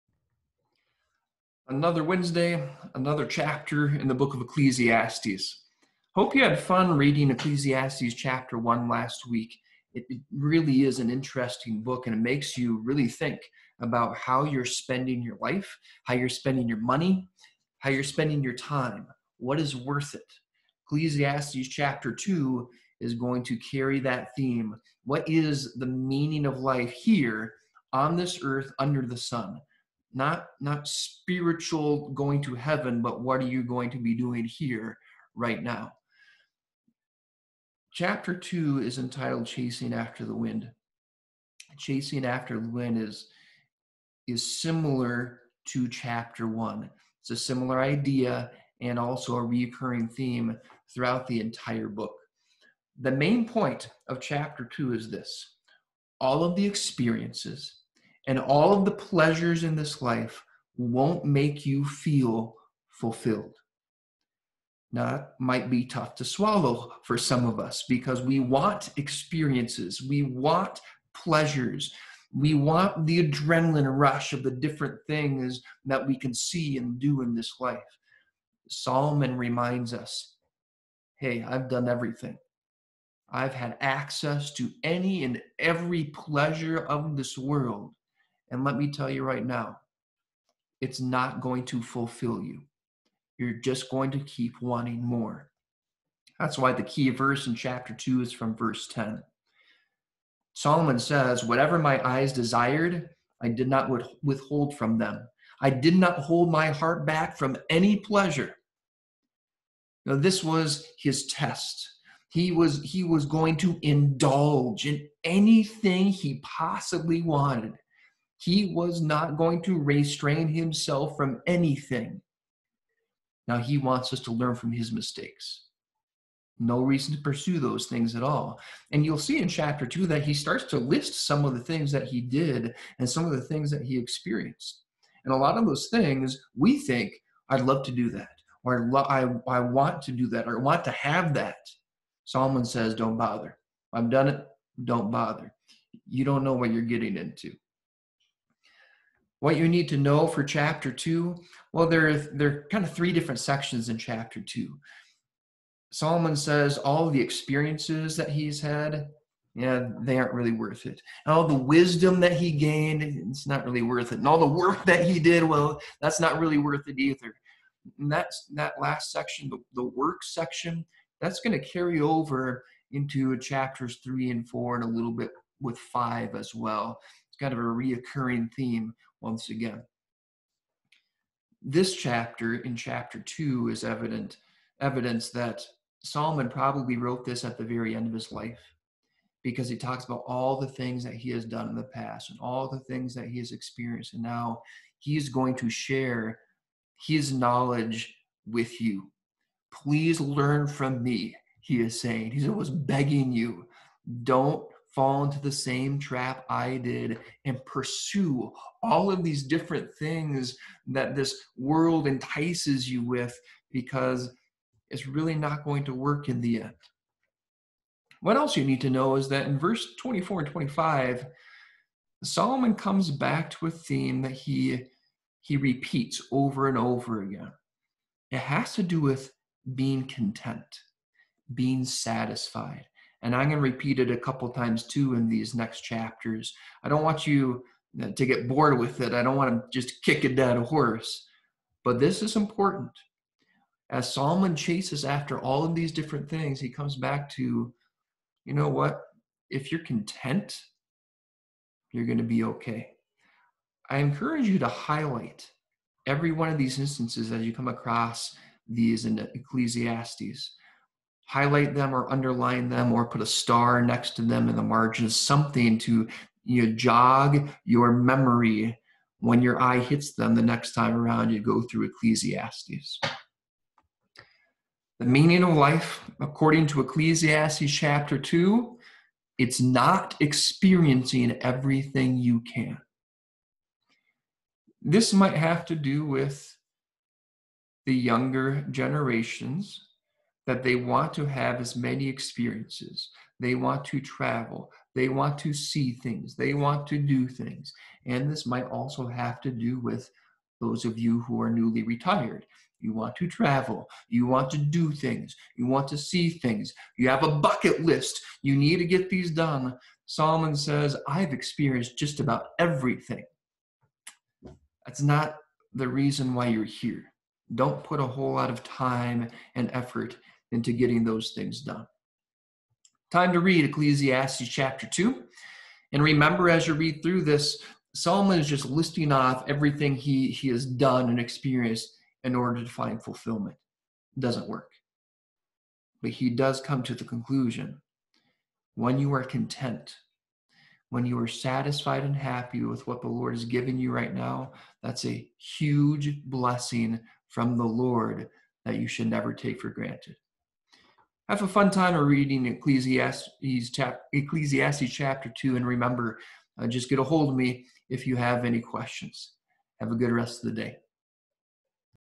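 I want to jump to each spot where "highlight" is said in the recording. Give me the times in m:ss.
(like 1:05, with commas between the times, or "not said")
4:14, 4:21.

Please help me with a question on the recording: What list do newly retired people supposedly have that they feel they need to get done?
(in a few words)
A bucket list.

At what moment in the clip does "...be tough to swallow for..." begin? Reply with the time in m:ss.
1:05.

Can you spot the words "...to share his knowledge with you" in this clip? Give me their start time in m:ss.
3:15.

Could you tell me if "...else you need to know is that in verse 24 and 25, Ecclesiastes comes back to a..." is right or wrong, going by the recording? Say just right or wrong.
wrong.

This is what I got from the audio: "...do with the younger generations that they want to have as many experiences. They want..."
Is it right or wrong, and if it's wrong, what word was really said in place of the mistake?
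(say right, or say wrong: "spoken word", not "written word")
right.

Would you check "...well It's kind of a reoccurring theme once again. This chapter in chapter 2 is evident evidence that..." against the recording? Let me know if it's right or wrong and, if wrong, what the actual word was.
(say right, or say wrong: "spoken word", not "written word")
right.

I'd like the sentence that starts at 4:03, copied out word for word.
As Solomon chases after all of these different things, he comes back to, you know what?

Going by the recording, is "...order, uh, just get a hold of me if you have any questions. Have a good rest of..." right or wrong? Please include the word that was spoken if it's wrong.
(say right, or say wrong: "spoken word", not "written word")
wrong: "remember", not "order".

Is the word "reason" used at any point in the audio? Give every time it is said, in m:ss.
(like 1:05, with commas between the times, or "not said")
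2:06, 5:15.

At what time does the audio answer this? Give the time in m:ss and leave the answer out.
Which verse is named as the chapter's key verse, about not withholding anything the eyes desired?
1:38.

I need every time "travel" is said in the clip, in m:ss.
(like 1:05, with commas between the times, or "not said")
4:53, 5:03.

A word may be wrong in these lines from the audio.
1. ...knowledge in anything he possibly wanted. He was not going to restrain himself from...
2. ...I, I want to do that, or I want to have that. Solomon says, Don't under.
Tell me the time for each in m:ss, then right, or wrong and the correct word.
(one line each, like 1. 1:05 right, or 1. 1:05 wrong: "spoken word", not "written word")
1. 1:53 wrong: "indulge", not "knowledge"
2. 2:19 wrong: "bother", not "under".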